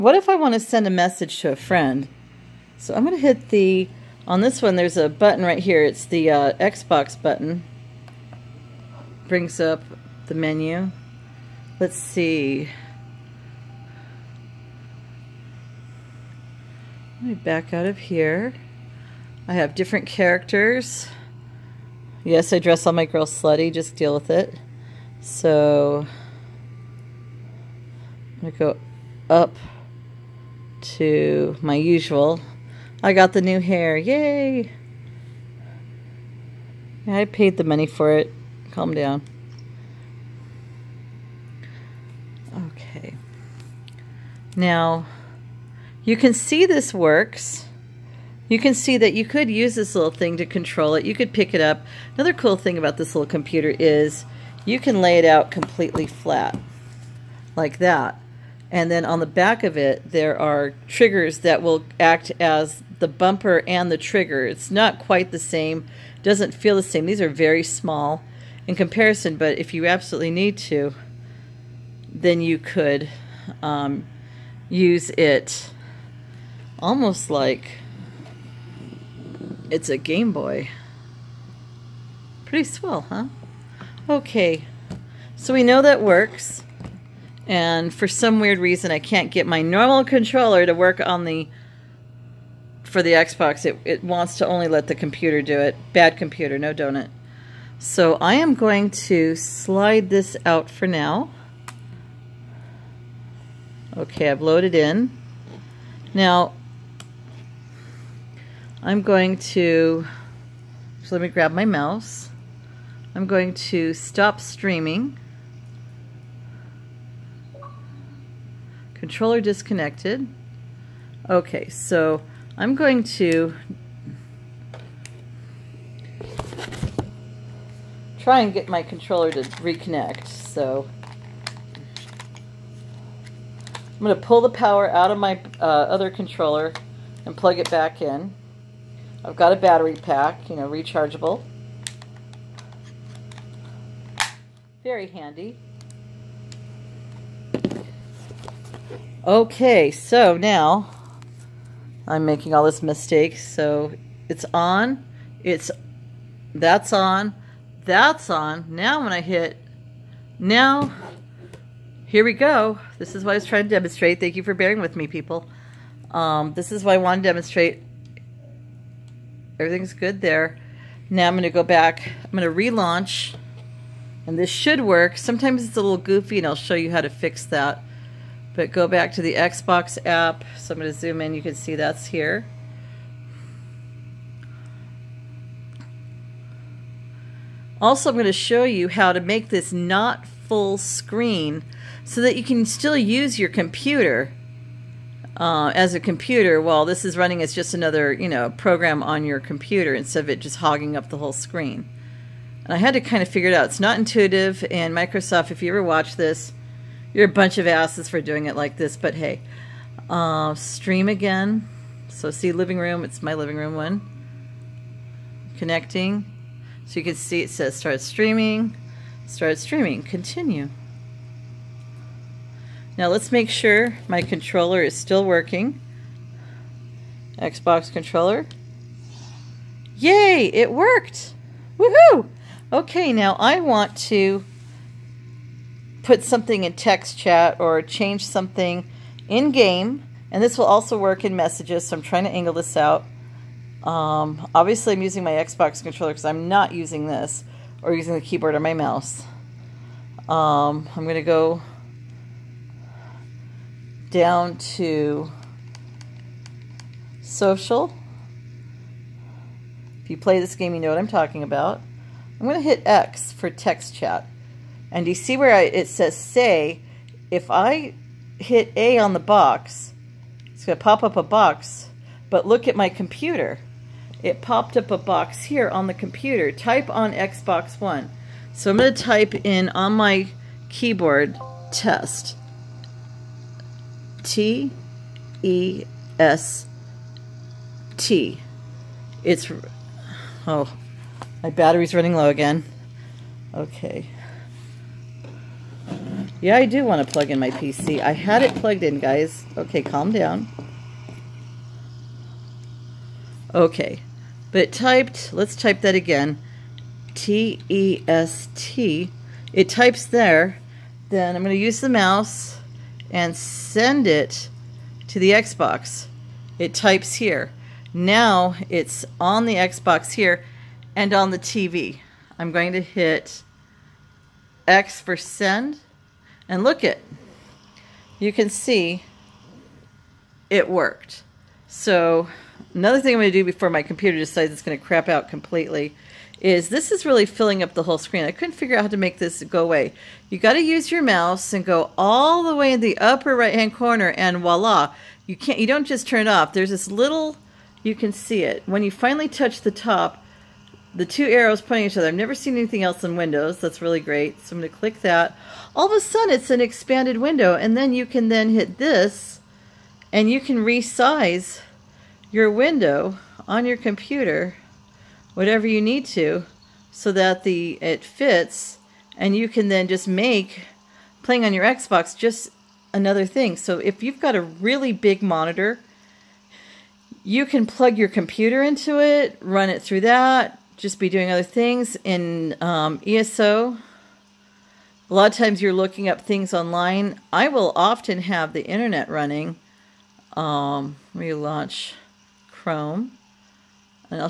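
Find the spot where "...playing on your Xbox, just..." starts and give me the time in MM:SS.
06:11.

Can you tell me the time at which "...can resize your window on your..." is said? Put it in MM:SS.
06:00.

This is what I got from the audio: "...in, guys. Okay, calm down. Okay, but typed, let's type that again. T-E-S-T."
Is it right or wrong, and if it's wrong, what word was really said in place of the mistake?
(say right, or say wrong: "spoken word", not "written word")
right.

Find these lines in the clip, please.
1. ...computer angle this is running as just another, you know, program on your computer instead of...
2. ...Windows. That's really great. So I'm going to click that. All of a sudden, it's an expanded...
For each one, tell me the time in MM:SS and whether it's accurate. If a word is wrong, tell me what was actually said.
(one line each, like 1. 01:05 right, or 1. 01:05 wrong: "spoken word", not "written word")
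1. 03:15 wrong: "while", not "angle"
2. 05:53 right.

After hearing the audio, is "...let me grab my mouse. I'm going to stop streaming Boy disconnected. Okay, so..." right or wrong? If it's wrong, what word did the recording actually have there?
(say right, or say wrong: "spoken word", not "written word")
wrong: "Controller", not "Boy".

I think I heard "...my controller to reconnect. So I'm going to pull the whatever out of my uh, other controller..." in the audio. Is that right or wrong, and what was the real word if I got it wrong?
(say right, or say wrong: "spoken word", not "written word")
wrong: "power", not "whatever".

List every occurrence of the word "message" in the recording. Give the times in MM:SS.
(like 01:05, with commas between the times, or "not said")
00:00, 04:01.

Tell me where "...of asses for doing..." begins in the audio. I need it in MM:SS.
03:27.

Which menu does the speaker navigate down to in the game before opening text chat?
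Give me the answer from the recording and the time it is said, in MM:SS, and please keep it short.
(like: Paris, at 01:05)
social, at 04:17.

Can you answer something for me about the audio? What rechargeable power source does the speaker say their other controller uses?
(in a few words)
battery pack.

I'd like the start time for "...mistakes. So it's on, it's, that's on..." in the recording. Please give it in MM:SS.
02:32.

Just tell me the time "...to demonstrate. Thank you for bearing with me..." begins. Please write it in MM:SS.
02:43.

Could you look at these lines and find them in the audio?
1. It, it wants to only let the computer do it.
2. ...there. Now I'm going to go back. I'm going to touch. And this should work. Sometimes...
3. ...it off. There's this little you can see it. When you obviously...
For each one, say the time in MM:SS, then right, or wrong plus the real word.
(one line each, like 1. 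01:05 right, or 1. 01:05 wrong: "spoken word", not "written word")
1. 01:33 right
2. 02:50 wrong: "relaunch", not "touch"
3. 05:46 wrong: "finally", not "obviously".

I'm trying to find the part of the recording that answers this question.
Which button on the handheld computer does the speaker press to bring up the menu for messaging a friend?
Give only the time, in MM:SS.
00:06.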